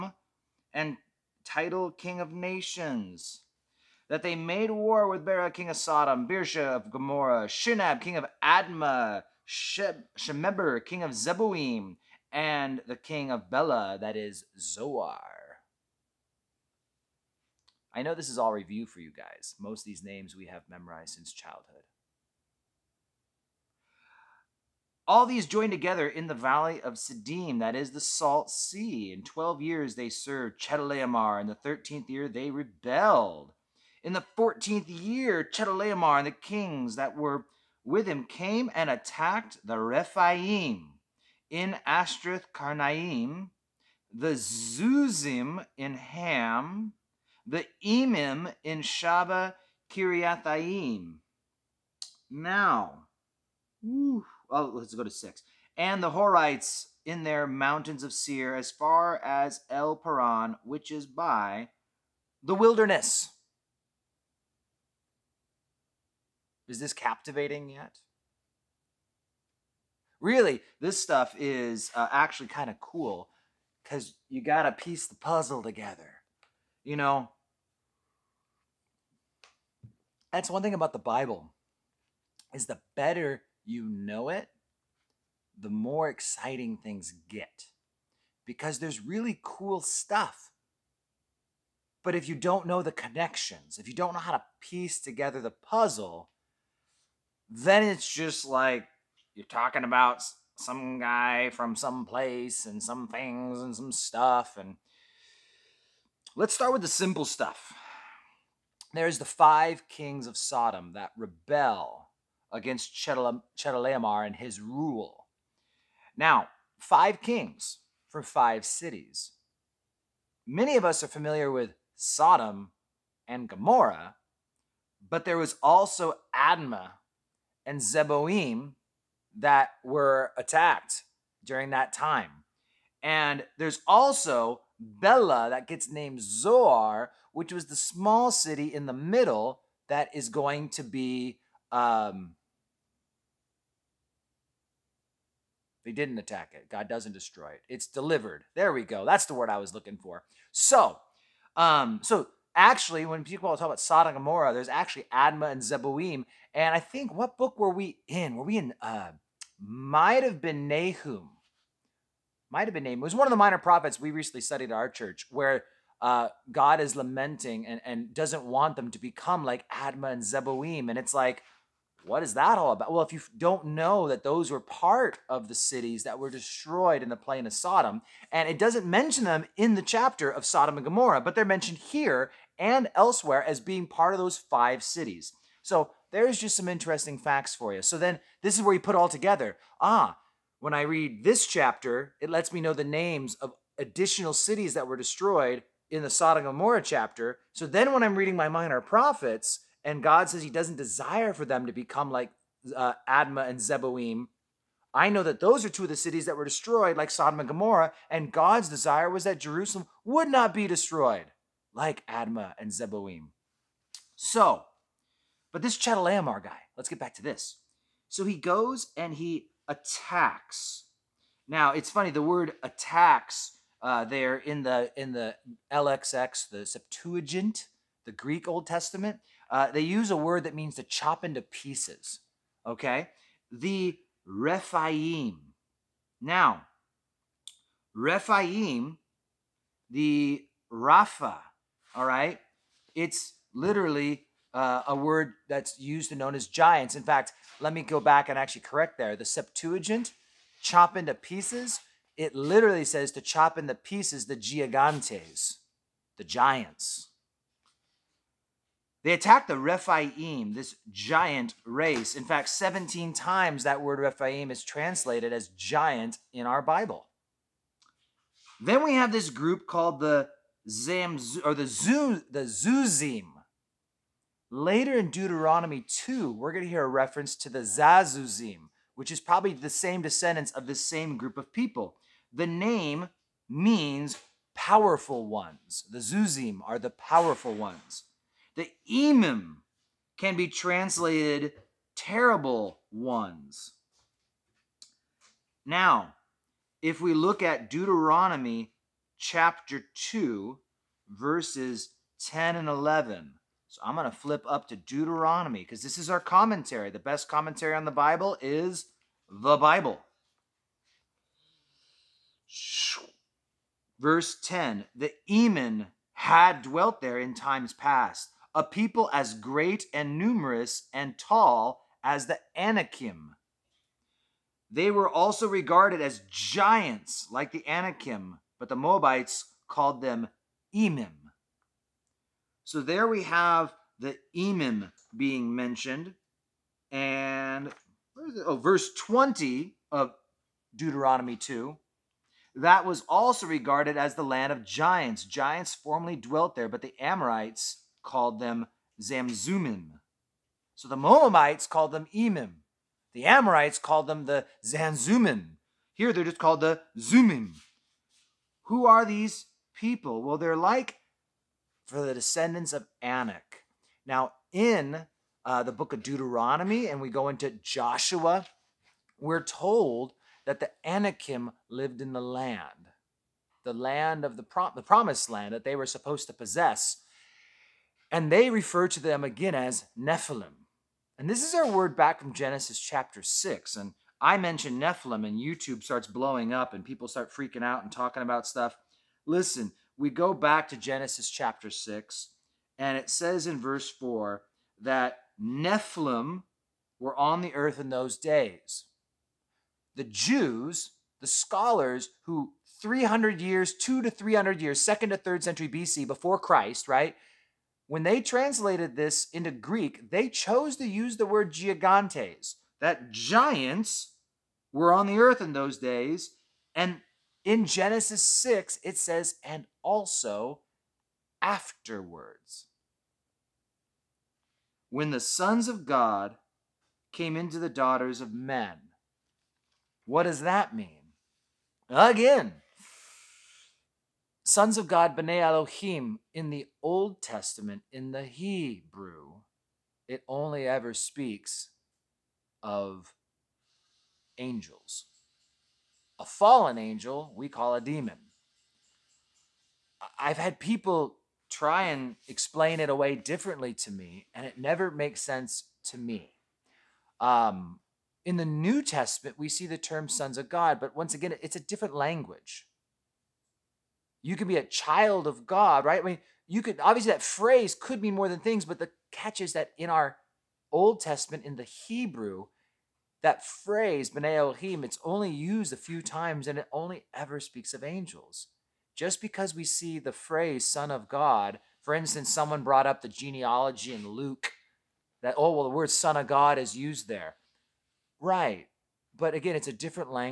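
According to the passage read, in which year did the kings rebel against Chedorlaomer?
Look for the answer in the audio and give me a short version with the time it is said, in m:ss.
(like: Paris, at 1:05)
13th year, at 0:31.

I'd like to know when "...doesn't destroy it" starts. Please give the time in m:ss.
2:26.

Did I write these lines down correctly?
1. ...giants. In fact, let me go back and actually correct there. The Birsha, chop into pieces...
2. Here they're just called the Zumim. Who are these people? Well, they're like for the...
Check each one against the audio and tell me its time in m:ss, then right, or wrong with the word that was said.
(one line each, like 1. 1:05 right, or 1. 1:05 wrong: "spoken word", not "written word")
1. 4:06 wrong: "Septuagint", not "Birsha"
2. 5:55 right.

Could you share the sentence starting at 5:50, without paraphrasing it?
So the Moabites called them Emim.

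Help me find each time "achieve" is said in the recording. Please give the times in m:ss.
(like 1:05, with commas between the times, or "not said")
not said.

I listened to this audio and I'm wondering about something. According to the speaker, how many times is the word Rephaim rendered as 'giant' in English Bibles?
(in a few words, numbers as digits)
17.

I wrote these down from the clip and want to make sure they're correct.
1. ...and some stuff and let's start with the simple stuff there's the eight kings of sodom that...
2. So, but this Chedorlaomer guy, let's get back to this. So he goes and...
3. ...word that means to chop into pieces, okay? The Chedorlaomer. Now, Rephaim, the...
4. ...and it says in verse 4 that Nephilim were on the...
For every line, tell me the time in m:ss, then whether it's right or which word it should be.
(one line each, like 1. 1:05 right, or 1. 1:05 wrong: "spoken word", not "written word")
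1. 1:43 wrong: "five", not "eight"
2. 3:34 right
3. 3:50 wrong: "Rephaim", not "Chedorlaomer"
4. 6:32 right.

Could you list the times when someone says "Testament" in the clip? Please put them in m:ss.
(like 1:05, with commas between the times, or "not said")
3:48, 7:17, 7:38, 7:50.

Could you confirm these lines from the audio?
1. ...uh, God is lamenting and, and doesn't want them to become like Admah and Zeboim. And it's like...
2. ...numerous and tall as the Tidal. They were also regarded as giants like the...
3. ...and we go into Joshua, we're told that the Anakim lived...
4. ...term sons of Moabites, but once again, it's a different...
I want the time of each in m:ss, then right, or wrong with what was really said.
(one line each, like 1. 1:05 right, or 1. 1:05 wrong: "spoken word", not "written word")
1. 2:46 right
2. 5:20 wrong: "Anakim", not "Tidal"
3. 6:06 right
4. 7:39 wrong: "God", not "Moabites".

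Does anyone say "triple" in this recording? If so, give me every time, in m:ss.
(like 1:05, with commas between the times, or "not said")
not said.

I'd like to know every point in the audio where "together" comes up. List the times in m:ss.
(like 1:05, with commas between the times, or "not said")
0:25, 1:15, 1:34, 3:09.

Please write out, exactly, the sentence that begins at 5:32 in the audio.
So there we have the Emim being mentioned.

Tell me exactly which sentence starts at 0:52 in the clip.
Now, whew, oh, let's go to six.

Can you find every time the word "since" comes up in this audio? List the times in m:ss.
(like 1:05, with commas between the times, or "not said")
0:21.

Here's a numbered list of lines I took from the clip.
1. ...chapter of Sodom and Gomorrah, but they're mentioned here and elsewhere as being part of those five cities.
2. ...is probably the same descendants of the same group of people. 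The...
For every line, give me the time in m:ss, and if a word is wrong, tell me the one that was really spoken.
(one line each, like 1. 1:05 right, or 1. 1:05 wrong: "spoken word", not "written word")
1. 2:59 right
2. 4:39 right.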